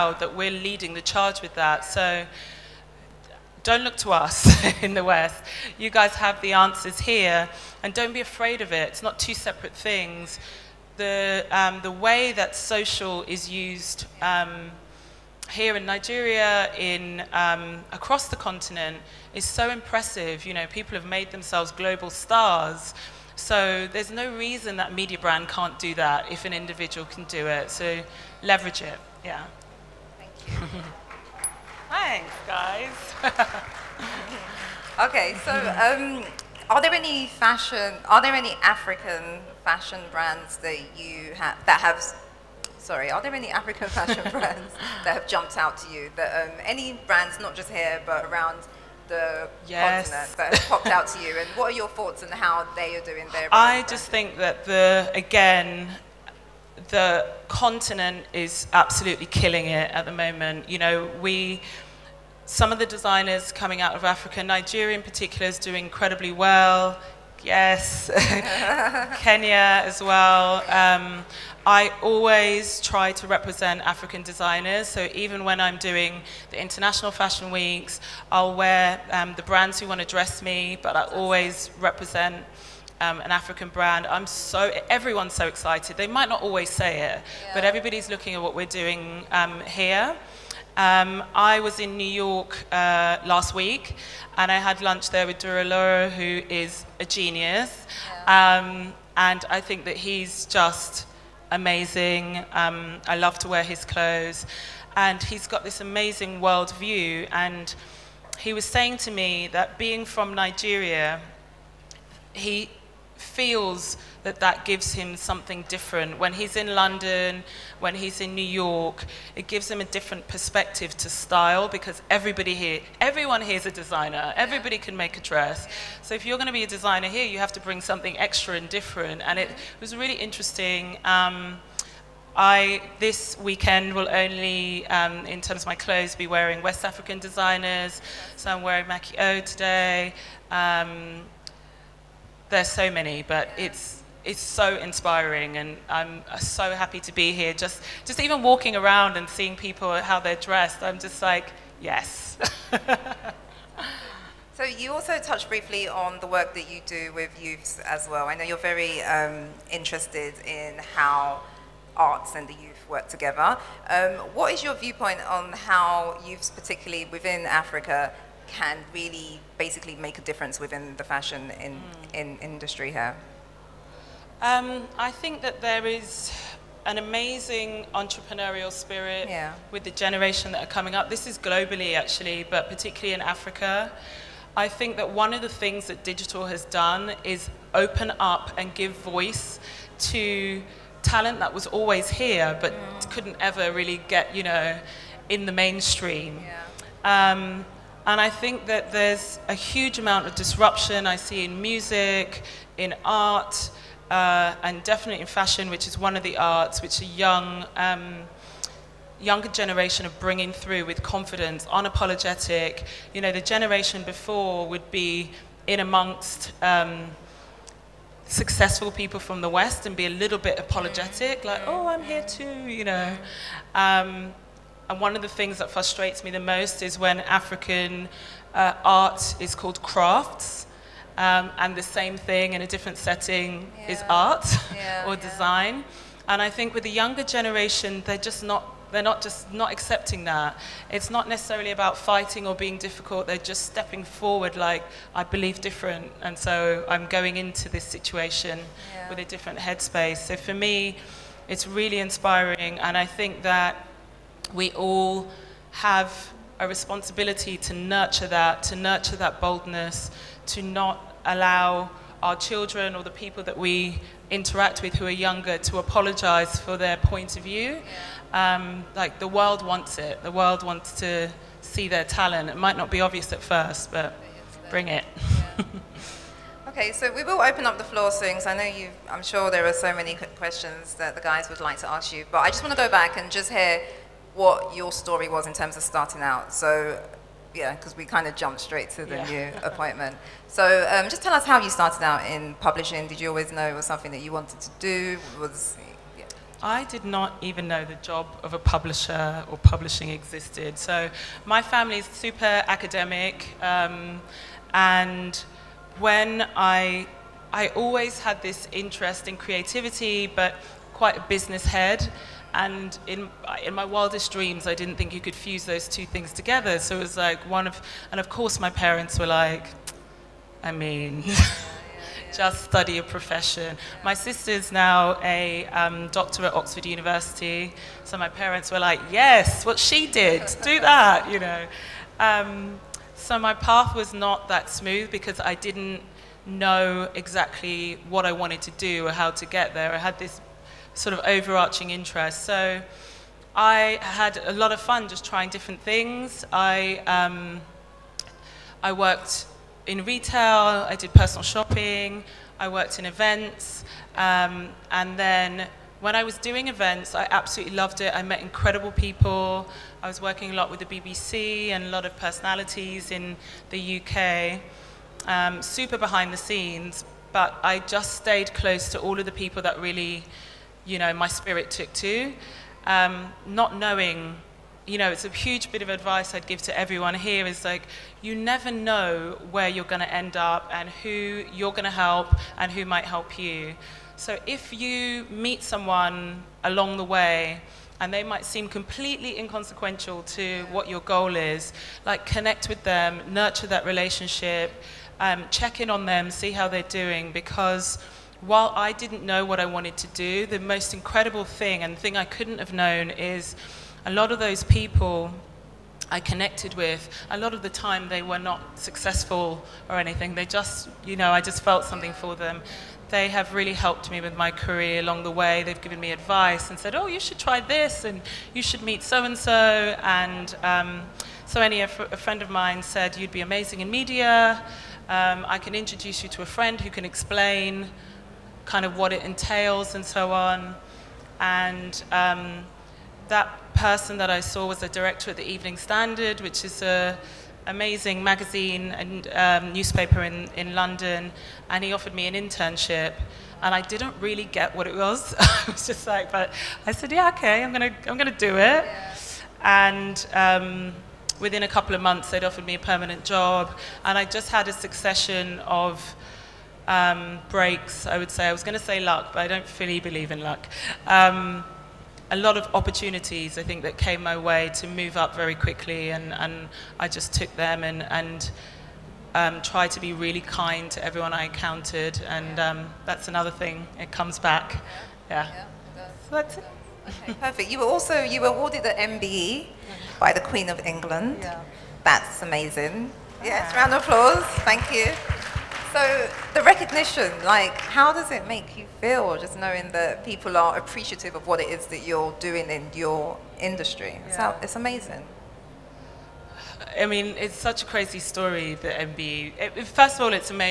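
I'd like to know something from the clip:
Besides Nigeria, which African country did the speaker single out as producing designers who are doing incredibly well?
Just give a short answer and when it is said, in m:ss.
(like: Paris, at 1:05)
Kenya, at 1:09.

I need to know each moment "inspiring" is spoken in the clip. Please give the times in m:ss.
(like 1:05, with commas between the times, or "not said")
2:24, 4:11.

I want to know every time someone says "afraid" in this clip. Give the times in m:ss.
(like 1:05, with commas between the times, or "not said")
0:08.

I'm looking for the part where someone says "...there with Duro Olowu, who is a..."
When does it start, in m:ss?
1:35.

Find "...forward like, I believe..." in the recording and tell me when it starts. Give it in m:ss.
4:04.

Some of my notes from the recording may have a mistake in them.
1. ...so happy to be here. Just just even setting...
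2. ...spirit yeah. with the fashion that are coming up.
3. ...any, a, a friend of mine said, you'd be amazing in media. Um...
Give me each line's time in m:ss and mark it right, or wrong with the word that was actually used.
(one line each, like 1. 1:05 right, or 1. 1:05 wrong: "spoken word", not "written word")
1. 2:26 wrong: "walking", not "setting"
2. 2:58 wrong: "generation", not "fashion"
3. 7:01 right.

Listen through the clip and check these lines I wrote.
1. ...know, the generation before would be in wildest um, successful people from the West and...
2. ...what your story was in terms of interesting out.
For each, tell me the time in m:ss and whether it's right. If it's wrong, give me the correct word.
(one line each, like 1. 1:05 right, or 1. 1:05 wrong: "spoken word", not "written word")
1. 3:33 wrong: "amongst", not "wildest"
2. 4:44 wrong: "starting", not "interesting".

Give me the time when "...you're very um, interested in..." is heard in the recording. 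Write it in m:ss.
2:38.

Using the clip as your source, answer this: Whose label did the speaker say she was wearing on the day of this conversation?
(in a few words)
Maki O.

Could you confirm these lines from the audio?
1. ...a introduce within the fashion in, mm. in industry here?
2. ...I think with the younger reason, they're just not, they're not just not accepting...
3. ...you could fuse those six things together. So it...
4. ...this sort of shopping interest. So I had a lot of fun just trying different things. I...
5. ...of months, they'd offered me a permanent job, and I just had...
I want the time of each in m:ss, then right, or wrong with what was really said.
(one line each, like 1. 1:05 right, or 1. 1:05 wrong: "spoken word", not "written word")
1. 2:50 wrong: "difference", not "introduce"
2. 3:56 wrong: "generation", not "reason"
3. 5:15 wrong: "two", not "six"
4. 5:40 wrong: "overarching", not "shopping"
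5. 7:31 right.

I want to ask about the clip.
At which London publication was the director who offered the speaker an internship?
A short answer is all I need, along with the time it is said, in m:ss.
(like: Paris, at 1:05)
Evening Standard, at 7:15.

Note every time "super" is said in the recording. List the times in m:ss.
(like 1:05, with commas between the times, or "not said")
5:02, 6:05.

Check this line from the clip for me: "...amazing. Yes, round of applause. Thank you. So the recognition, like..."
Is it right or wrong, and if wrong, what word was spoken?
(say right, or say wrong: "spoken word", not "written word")
right.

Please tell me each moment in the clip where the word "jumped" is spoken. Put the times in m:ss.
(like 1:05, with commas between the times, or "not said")
0:45, 4:48.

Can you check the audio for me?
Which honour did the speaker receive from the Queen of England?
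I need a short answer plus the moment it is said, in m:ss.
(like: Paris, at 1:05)
MBE, at 7:58.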